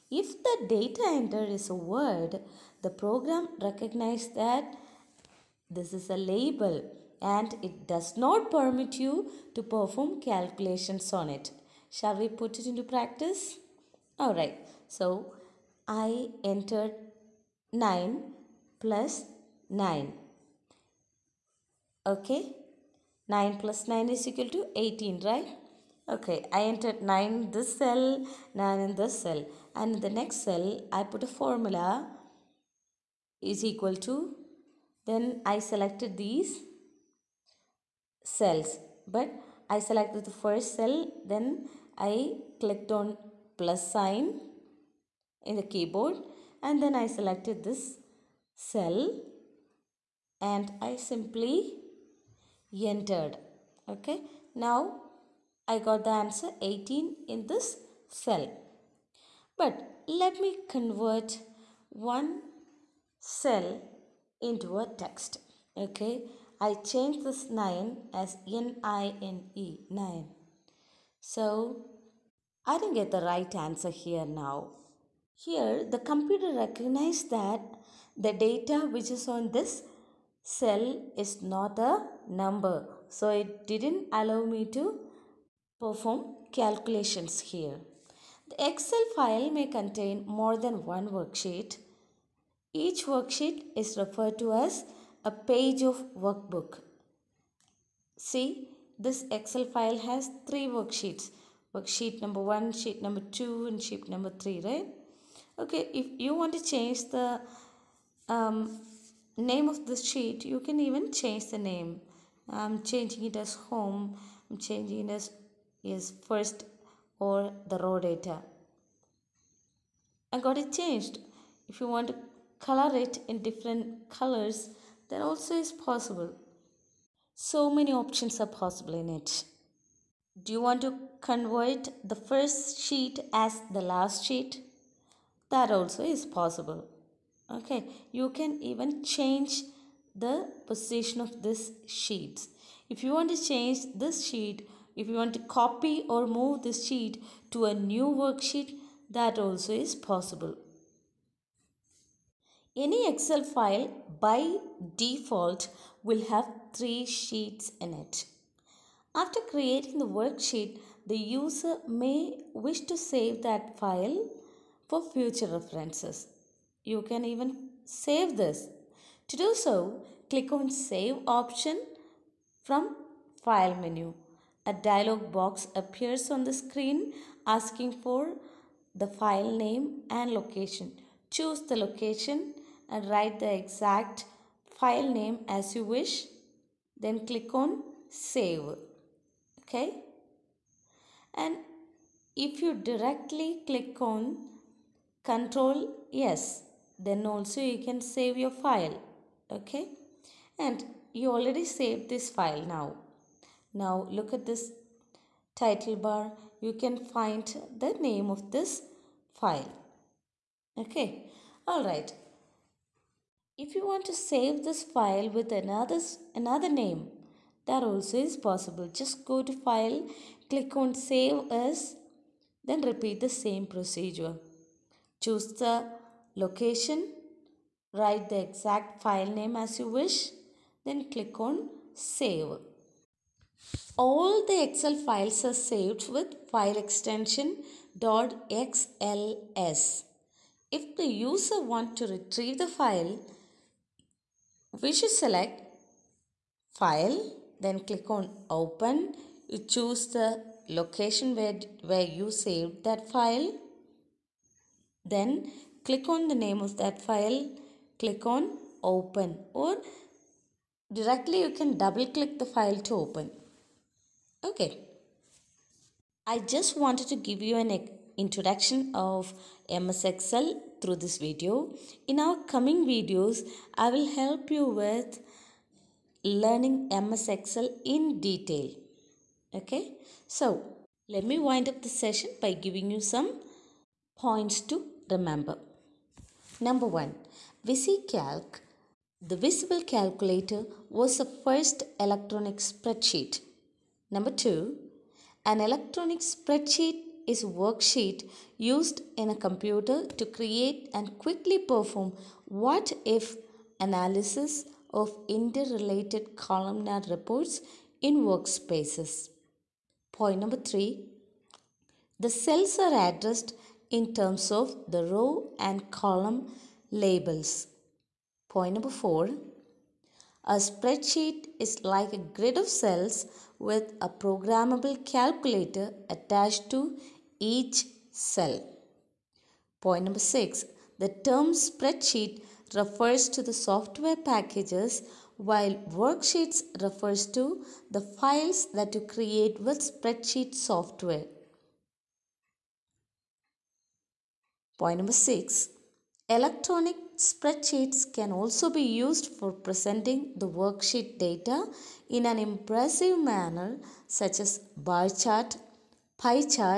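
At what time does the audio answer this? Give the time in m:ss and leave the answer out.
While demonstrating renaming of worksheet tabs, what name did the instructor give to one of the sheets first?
1:53.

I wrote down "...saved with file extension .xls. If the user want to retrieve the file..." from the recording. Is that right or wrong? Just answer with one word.
right.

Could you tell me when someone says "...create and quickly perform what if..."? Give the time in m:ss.
5:00.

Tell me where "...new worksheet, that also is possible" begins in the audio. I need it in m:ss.
2:27.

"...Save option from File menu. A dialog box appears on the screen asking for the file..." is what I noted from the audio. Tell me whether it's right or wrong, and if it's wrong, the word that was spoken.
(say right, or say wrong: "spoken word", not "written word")
right.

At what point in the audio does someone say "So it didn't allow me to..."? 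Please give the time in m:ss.
1:23.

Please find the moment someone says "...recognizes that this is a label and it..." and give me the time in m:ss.
0:03.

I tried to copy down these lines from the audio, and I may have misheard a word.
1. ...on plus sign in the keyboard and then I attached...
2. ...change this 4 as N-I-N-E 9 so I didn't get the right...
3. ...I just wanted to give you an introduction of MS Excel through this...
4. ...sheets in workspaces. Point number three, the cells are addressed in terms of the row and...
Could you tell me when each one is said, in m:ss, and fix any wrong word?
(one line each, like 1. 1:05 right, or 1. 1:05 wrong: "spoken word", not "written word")
1. 0:43 wrong: "selected", not "attached"
2. 1:06 wrong: "9", not "4"
3. 4:26 right
4. 5:07 wrong: "reports", not "sheets".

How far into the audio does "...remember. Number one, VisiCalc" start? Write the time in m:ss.
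4:45.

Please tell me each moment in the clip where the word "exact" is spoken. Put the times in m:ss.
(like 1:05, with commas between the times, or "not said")
3:03, 3:48.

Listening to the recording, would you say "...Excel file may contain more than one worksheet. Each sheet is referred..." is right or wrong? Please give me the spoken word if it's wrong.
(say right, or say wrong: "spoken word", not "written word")
wrong: "worksheet", not "sheet".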